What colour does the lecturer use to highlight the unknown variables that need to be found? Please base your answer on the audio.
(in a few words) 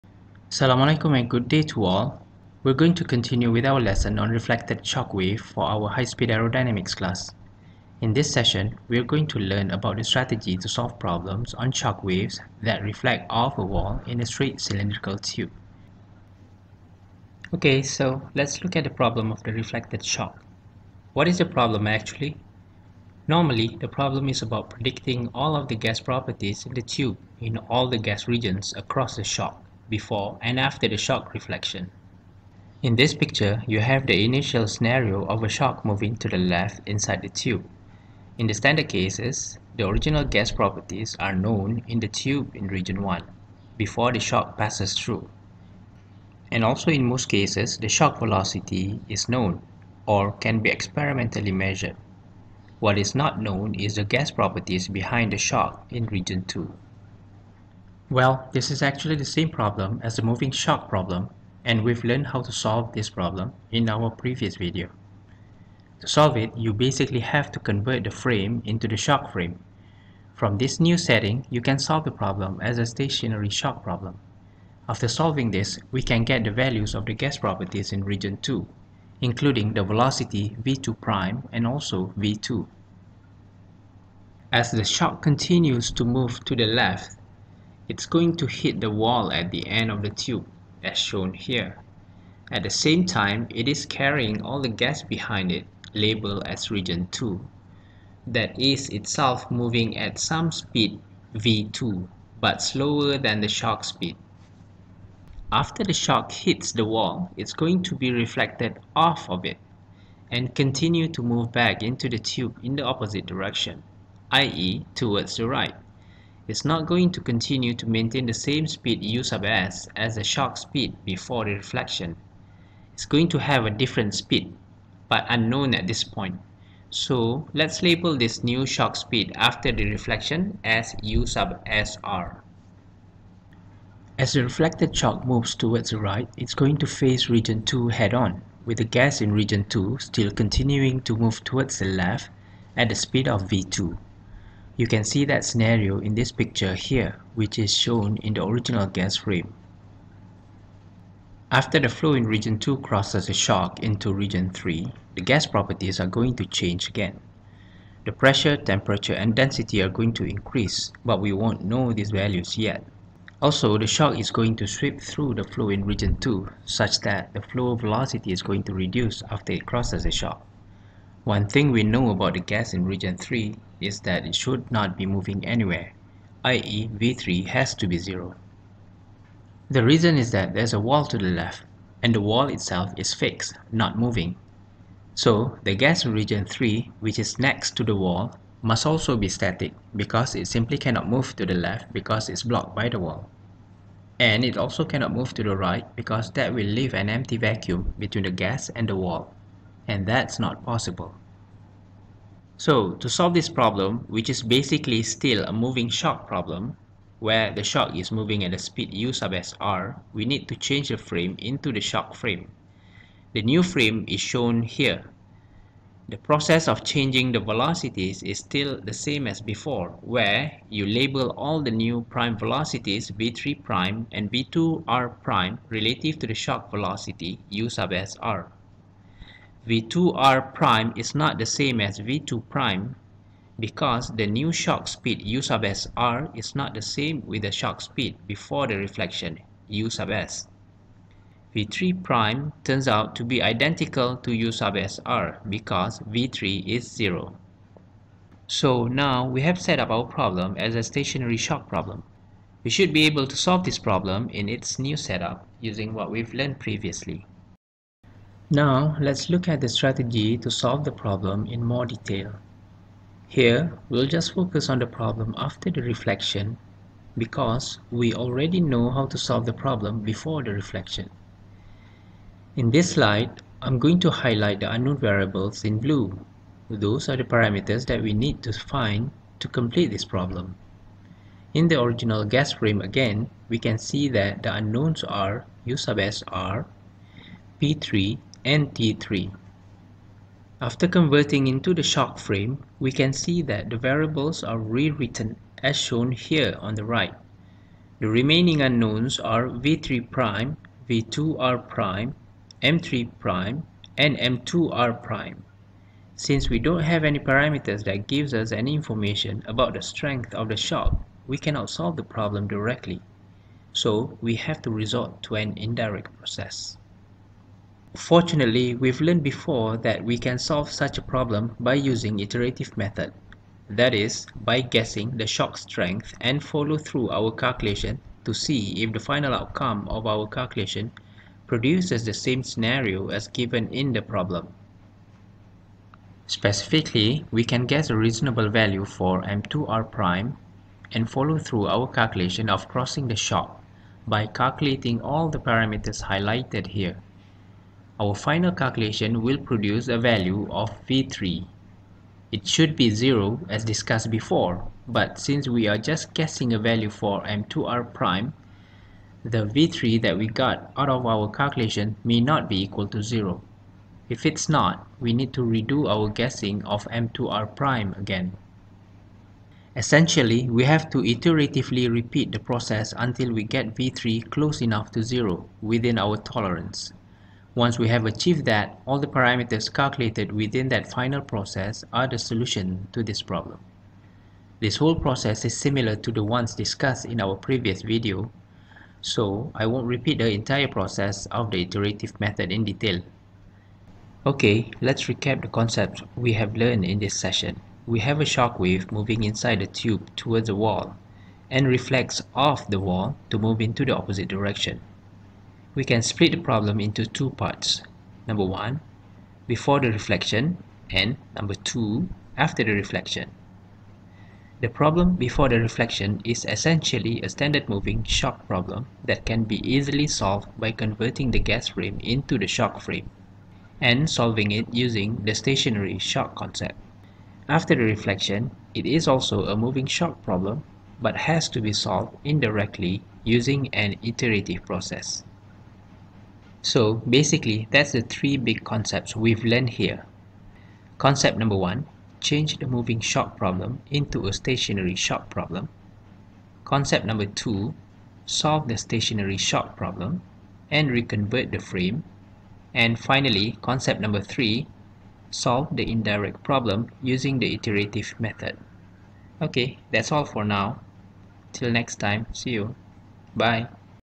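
Blue.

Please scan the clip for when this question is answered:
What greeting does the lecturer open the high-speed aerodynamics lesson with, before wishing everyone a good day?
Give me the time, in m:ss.
0:00.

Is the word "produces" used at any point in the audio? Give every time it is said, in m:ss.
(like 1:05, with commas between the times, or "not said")
5:31, 5:49.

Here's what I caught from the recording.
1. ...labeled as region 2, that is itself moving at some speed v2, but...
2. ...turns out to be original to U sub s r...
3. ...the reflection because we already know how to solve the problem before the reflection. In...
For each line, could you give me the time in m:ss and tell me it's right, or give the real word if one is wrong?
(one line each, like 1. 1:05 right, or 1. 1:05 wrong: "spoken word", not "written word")
1. 1:35 right
2. 4:02 wrong: "identical", not "original"
3. 4:25 right.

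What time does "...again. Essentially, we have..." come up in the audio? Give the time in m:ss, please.
6:07.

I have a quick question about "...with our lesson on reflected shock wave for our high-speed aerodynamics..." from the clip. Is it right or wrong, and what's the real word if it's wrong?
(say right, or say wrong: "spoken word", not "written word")
right.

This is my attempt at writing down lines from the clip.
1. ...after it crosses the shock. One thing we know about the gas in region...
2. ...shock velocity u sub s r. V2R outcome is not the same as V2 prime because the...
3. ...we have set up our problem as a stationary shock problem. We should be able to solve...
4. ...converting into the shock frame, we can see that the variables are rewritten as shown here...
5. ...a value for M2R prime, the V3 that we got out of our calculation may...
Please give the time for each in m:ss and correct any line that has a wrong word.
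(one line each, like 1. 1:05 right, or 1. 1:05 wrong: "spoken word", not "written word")
1. 2:49 right
2. 3:46 wrong: "prime", not "outcome"
3. 4:09 right
4. 4:50 right
5. 5:56 right.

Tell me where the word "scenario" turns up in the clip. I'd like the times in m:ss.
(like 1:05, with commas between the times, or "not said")
0:34, 2:25, 5:32.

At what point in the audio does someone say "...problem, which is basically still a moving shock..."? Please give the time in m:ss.
3:23.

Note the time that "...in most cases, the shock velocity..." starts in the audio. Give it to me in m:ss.
0:46.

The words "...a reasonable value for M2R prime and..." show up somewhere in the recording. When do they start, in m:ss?
5:37.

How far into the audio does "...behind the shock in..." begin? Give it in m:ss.
0:54.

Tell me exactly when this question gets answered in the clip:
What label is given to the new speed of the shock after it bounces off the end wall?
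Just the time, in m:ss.
2:11.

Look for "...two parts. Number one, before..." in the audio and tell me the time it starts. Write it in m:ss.
6:47.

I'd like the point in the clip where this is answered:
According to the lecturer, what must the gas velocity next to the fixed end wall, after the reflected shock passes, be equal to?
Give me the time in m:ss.
2:56.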